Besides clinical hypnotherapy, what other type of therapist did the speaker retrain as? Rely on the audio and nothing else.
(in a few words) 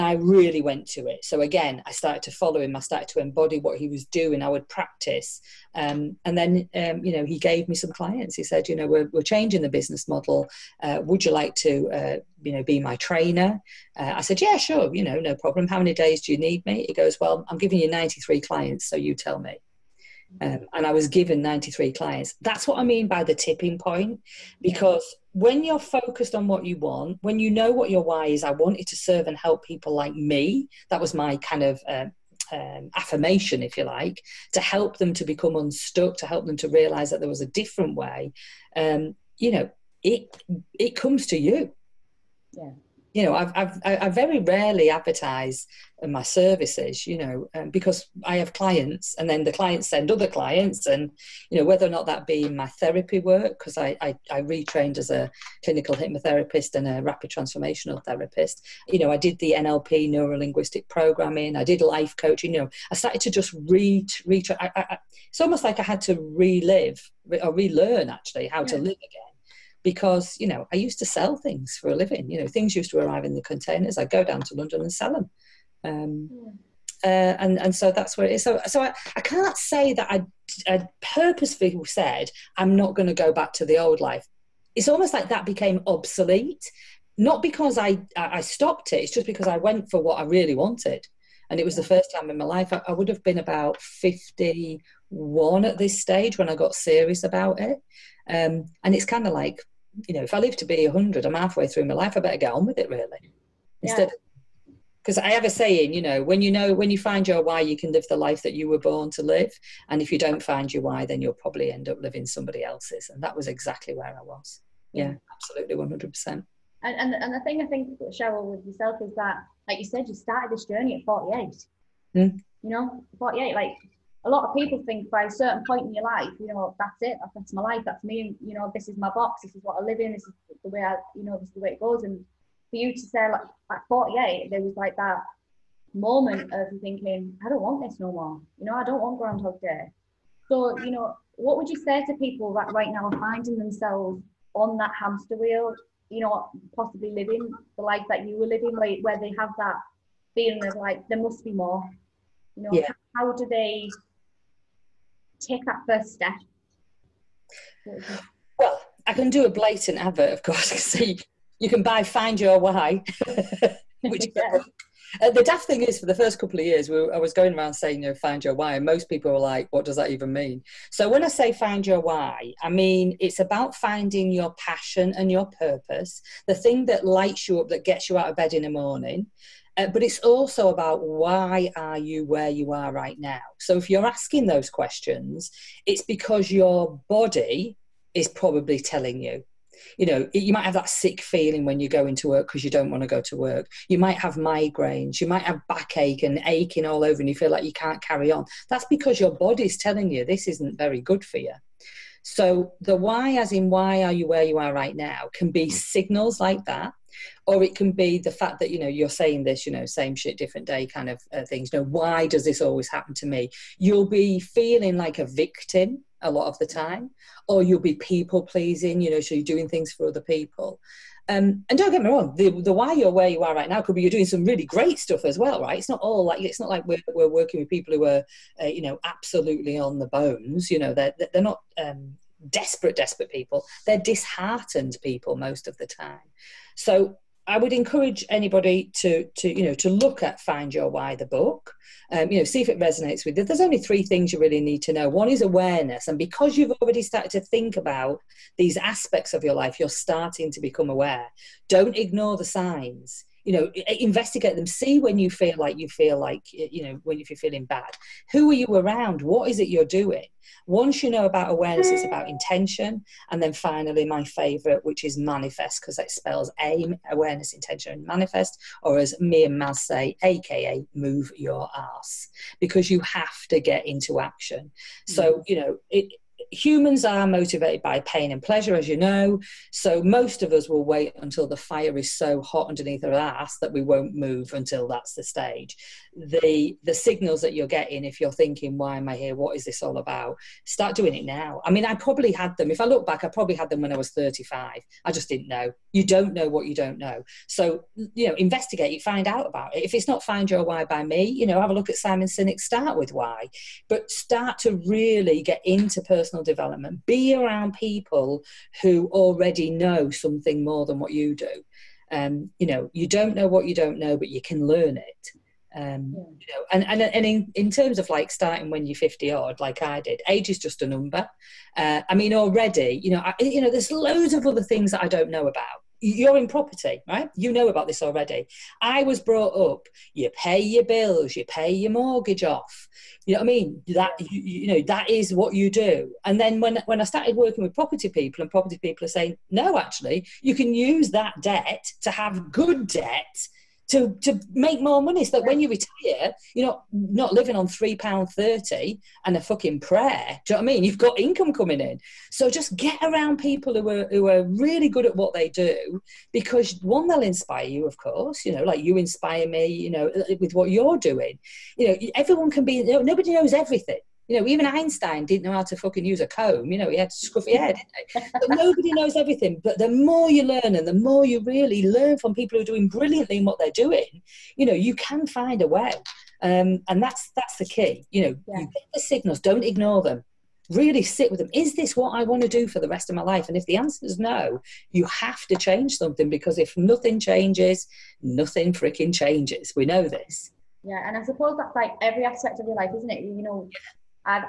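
Rapid transformational therapist.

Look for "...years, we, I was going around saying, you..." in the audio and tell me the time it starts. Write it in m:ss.
2:46.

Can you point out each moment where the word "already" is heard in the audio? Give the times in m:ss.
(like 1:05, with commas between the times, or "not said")
4:06, 5:09, 5:22, 5:28.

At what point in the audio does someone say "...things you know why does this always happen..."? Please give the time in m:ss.
3:31.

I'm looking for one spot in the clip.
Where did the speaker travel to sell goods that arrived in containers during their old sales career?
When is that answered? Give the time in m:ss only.
1:14.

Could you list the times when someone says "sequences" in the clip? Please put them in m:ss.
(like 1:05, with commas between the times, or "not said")
not said.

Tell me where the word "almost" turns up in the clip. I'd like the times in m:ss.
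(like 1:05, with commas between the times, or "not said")
1:05, 1:24.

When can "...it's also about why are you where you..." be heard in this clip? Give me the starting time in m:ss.
3:00.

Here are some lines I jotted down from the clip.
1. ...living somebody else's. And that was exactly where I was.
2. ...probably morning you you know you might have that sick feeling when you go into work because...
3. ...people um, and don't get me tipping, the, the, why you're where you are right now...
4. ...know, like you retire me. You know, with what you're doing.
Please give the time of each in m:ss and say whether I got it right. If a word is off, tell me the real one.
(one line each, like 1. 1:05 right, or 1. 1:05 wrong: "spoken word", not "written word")
1. 1:52 right
2. 3:08 wrong: "telling", not "morning"
3. 3:40 wrong: "wrong", not "tipping"
4. 5:58 wrong: "inspire", not "retire".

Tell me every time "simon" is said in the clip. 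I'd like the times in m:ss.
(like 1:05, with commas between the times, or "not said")
5:01.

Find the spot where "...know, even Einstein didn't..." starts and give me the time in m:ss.
6:04.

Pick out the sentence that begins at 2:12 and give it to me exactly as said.
And for you to say like at 48, there was like that moment of thinking, I don't want this no more.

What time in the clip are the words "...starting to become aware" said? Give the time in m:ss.
4:10.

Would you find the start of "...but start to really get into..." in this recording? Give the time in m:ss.
5:03.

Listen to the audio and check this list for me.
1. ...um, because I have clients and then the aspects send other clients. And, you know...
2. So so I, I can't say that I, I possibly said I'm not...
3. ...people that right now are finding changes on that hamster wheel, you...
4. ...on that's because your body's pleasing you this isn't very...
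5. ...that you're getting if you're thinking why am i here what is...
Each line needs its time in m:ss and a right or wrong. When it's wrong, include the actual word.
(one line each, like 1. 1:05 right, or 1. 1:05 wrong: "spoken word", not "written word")
1. 0:47 wrong: "clients", not "aspects"
2. 1:18 wrong: "purposefully", not "possibly"
3. 2:22 wrong: "themselves", not "changes"
4. 3:18 wrong: "telling", not "pleasing"
5. 4:47 right.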